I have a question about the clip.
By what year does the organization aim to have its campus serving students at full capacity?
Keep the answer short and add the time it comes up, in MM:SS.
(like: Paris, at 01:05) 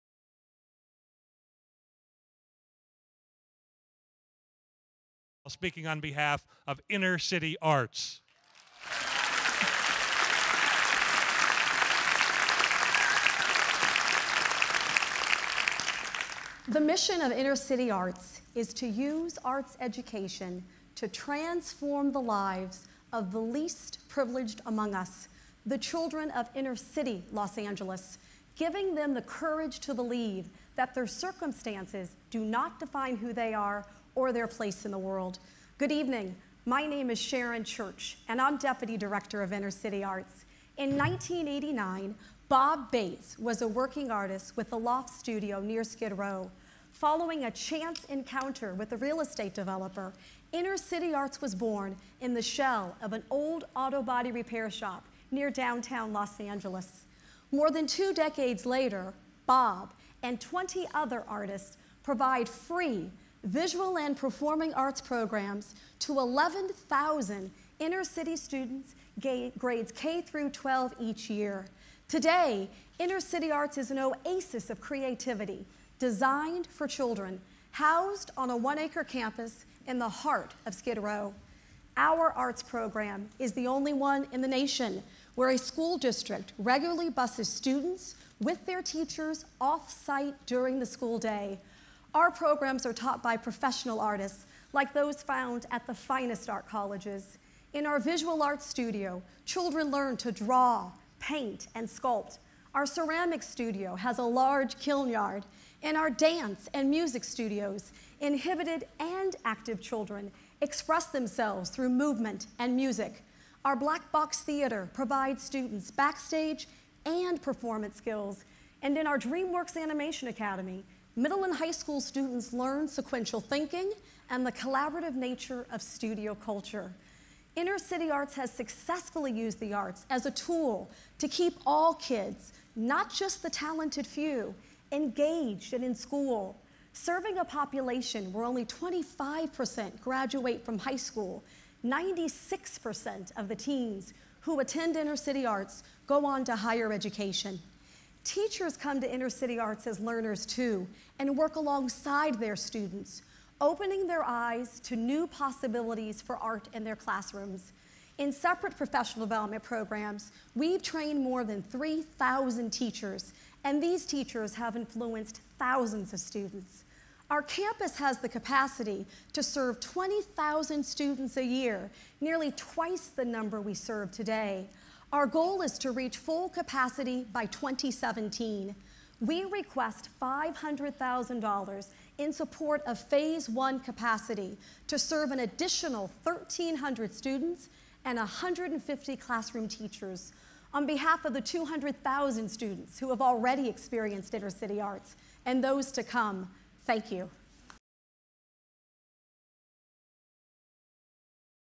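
2017, at 02:57.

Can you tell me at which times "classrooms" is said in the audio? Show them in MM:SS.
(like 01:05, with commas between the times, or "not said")
02:36, 03:09.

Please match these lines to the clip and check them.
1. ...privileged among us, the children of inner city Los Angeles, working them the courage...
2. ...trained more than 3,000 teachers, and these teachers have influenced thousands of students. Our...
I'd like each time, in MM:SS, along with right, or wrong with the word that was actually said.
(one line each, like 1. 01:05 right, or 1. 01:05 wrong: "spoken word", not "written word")
1. 00:24 wrong: "giving", not "working"
2. 02:40 right.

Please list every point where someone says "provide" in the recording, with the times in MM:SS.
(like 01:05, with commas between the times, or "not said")
01:02, 01:54.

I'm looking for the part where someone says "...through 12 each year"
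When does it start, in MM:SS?
01:10.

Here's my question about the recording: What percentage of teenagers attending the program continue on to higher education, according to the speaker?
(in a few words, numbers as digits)
96%.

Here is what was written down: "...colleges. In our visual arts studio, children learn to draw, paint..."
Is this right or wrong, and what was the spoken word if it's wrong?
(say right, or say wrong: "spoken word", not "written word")
right.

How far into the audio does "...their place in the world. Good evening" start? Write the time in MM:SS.
00:34.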